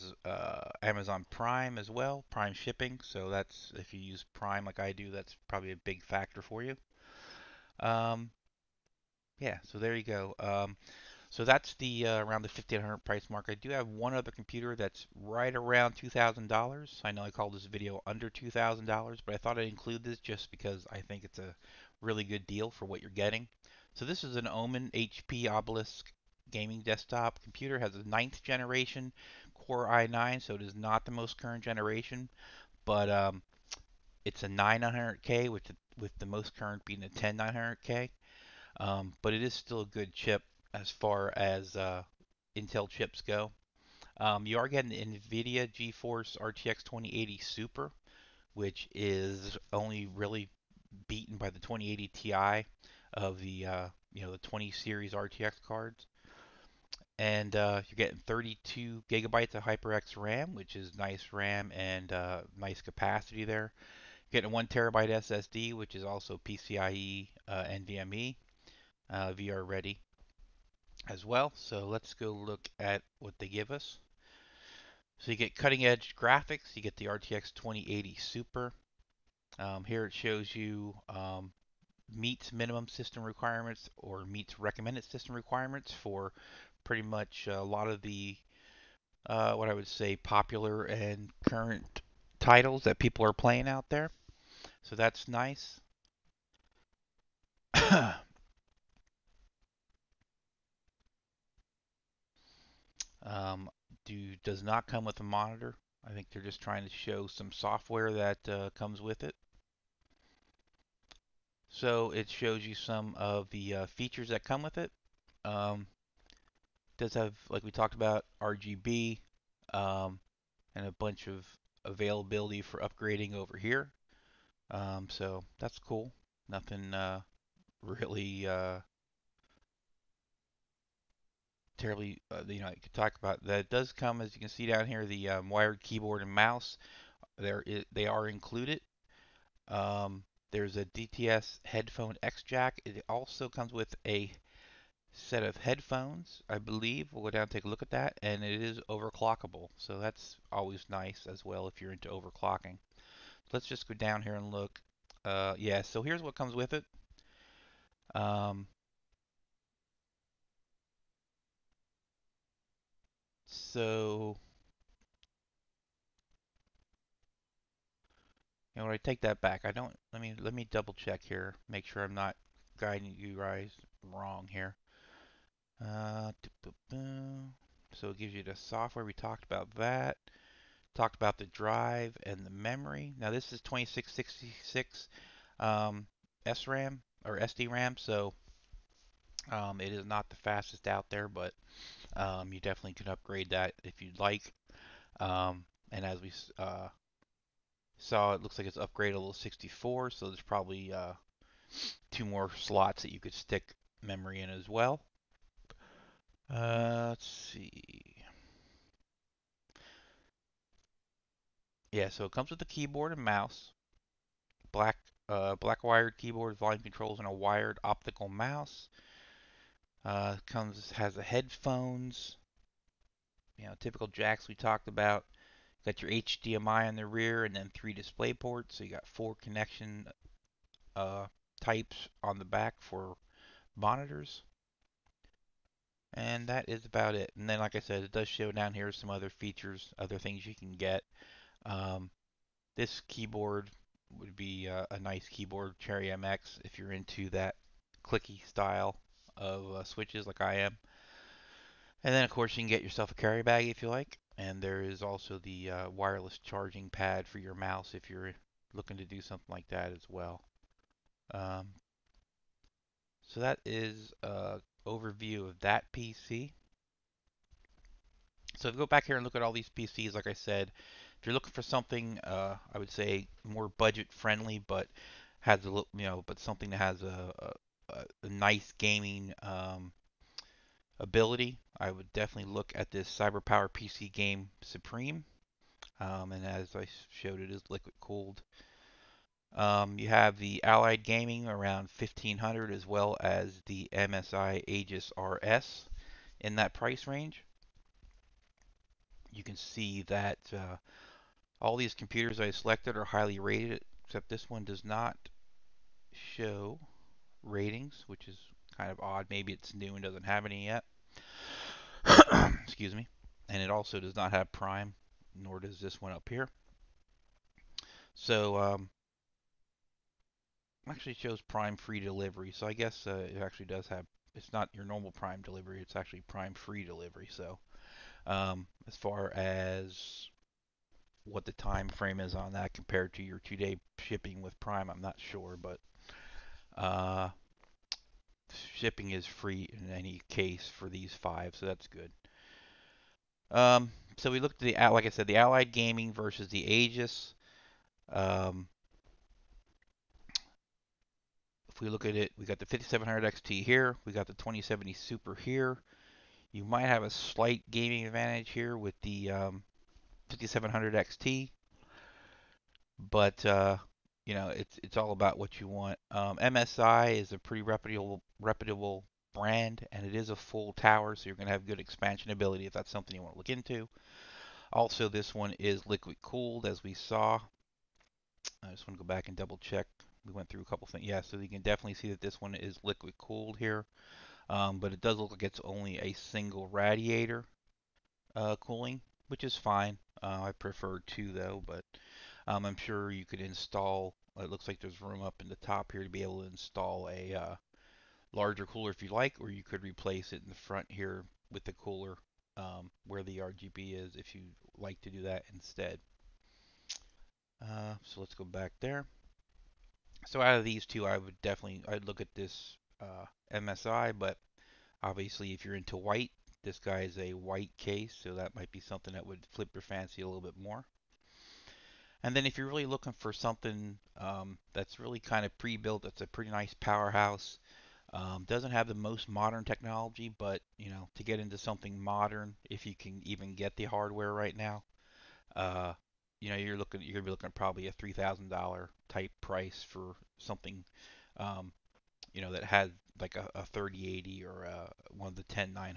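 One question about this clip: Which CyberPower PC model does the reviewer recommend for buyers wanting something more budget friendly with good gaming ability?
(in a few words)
Game Supreme.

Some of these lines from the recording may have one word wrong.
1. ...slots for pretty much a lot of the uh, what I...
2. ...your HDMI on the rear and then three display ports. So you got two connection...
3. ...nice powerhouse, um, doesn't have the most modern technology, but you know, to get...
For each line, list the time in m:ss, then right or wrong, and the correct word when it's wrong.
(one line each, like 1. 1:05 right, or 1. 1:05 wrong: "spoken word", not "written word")
1. 1:25 wrong: "requirements", not "slots"
2. 3:46 wrong: "four", not "two"
3. 7:06 right.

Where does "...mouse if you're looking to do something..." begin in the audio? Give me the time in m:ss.
4:17.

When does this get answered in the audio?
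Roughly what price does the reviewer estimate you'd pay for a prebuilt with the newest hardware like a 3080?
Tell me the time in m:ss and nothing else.
7:17.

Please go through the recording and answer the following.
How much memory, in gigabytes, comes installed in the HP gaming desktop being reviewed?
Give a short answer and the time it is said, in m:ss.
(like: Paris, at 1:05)
32, at 0:58.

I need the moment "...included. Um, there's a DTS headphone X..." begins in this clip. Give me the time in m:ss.
2:18.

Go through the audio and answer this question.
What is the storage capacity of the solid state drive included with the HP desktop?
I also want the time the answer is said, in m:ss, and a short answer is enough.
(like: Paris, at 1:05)
1 terabyte, at 1:04.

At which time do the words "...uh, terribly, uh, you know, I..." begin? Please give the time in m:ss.
2:08.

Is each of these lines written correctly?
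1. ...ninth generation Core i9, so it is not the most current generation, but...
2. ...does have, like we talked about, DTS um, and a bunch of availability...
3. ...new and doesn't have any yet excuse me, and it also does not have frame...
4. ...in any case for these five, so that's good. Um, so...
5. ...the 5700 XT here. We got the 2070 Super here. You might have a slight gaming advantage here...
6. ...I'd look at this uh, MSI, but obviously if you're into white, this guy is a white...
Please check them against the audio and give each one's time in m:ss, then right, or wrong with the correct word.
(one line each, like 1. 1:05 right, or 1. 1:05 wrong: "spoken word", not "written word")
1. 0:28 right
2. 1:56 wrong: "RGB", not "DTS"
3. 5:09 wrong: "prime", not "frame"
4. 5:39 right
5. 5:52 right
6. 6:51 right.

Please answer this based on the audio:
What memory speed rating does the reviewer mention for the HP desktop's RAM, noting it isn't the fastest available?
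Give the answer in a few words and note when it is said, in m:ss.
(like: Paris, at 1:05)
2666, at 3:03.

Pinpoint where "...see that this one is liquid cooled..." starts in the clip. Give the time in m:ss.
6:21.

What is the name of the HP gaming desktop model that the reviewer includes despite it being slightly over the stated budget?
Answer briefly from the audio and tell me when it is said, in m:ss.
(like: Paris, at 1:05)
Omen HP Obelisk, at 0:24.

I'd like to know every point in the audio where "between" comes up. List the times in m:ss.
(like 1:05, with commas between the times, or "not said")
not said.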